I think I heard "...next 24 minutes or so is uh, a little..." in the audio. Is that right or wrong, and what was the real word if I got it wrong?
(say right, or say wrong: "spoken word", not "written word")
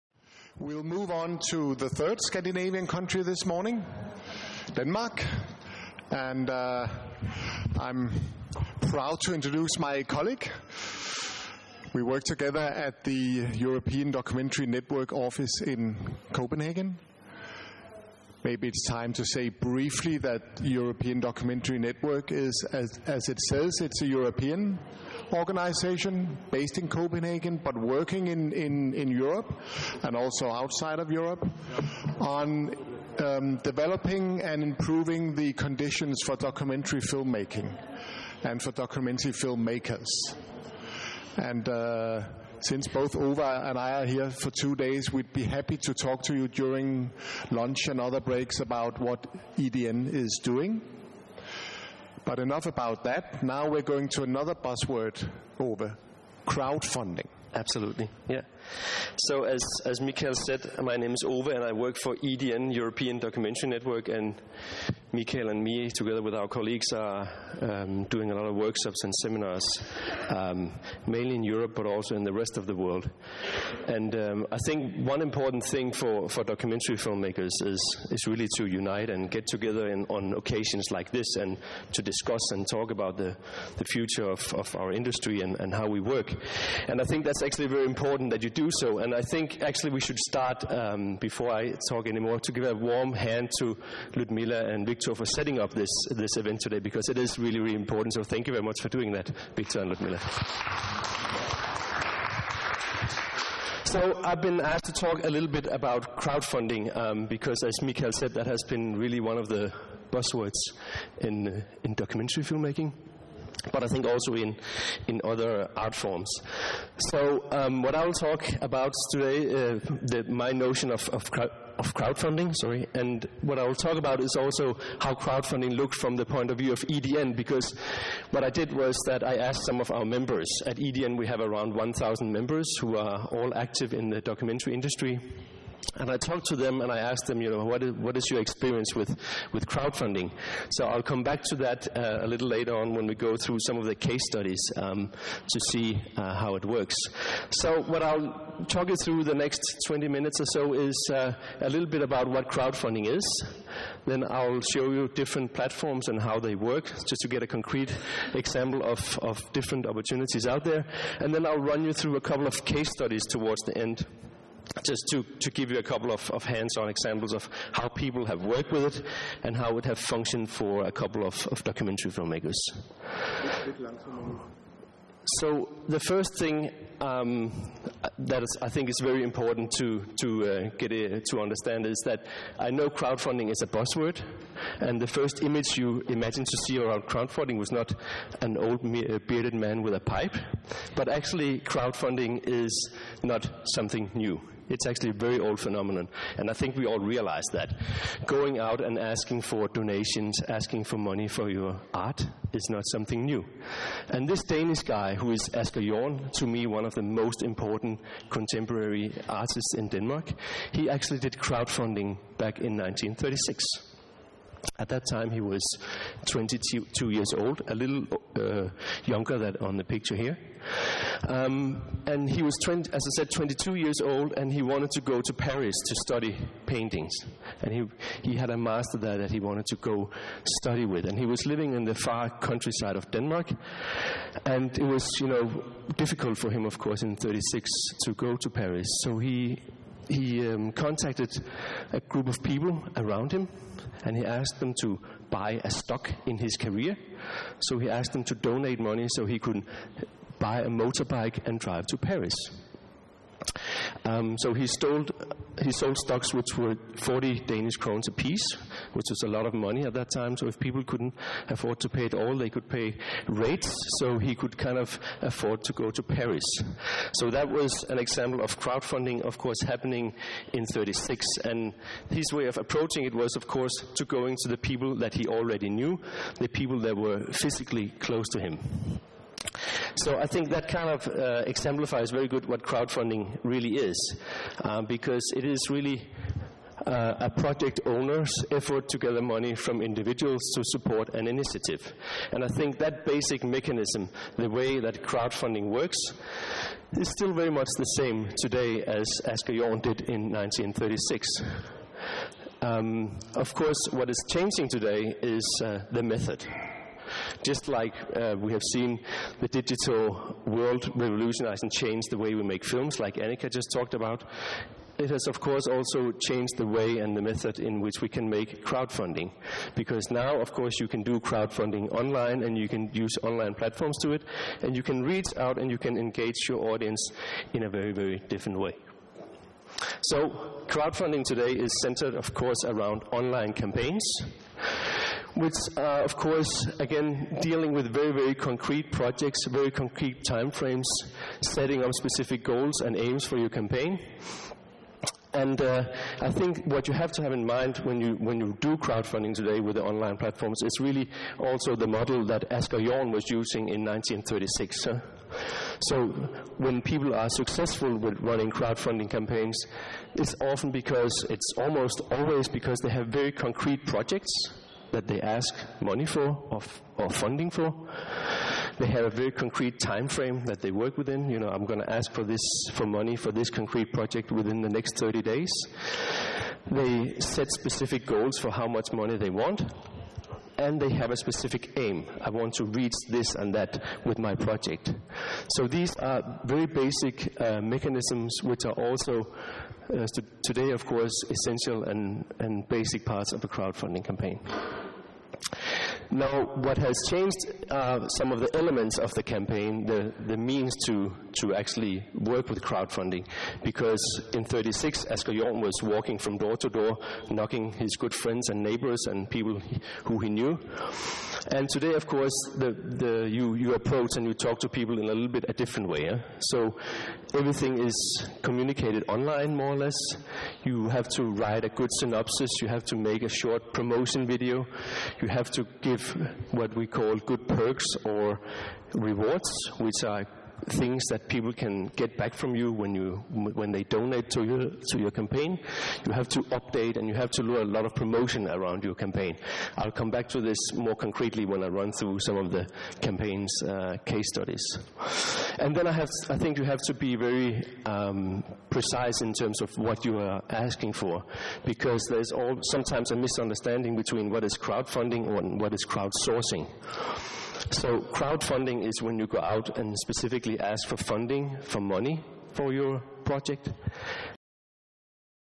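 wrong: "20", not "24".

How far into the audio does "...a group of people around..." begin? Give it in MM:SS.
04:01.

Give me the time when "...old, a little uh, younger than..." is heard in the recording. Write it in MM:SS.
03:37.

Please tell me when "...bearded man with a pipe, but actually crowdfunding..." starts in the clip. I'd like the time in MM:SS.
03:09.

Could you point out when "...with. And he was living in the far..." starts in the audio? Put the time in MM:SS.
03:50.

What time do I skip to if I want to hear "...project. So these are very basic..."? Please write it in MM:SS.
06:24.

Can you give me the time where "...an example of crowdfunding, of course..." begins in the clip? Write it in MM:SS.
04:27.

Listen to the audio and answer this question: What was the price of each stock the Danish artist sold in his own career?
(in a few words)
40 Danish krones.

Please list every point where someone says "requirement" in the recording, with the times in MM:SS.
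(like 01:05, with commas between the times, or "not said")
not said.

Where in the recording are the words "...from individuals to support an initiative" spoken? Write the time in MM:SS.
04:49.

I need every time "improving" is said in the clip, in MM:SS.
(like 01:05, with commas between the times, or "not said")
00:34.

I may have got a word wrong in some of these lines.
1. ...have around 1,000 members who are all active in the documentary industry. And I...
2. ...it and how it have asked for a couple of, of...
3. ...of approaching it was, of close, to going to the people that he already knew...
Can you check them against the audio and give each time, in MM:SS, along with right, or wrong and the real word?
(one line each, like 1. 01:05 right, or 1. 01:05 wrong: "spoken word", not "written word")
1. 02:11 right
2. 02:48 wrong: "functioned", not "asked"
3. 04:32 wrong: "course", not "close".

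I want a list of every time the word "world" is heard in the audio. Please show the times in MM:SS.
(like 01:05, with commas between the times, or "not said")
01:12, 05:10.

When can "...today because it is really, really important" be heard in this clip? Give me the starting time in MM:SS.
01:36.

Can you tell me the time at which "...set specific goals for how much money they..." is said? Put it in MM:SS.
06:17.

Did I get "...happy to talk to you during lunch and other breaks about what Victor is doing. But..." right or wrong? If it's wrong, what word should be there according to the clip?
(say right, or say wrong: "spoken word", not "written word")
wrong: "EDN", not "Victor".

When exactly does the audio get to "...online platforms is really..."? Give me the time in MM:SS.
05:49.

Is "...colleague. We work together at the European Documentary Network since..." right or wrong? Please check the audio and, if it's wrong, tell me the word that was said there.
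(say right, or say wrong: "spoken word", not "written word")
wrong: "office", not "since".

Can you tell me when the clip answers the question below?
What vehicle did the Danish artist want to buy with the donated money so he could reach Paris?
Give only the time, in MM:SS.
04:10.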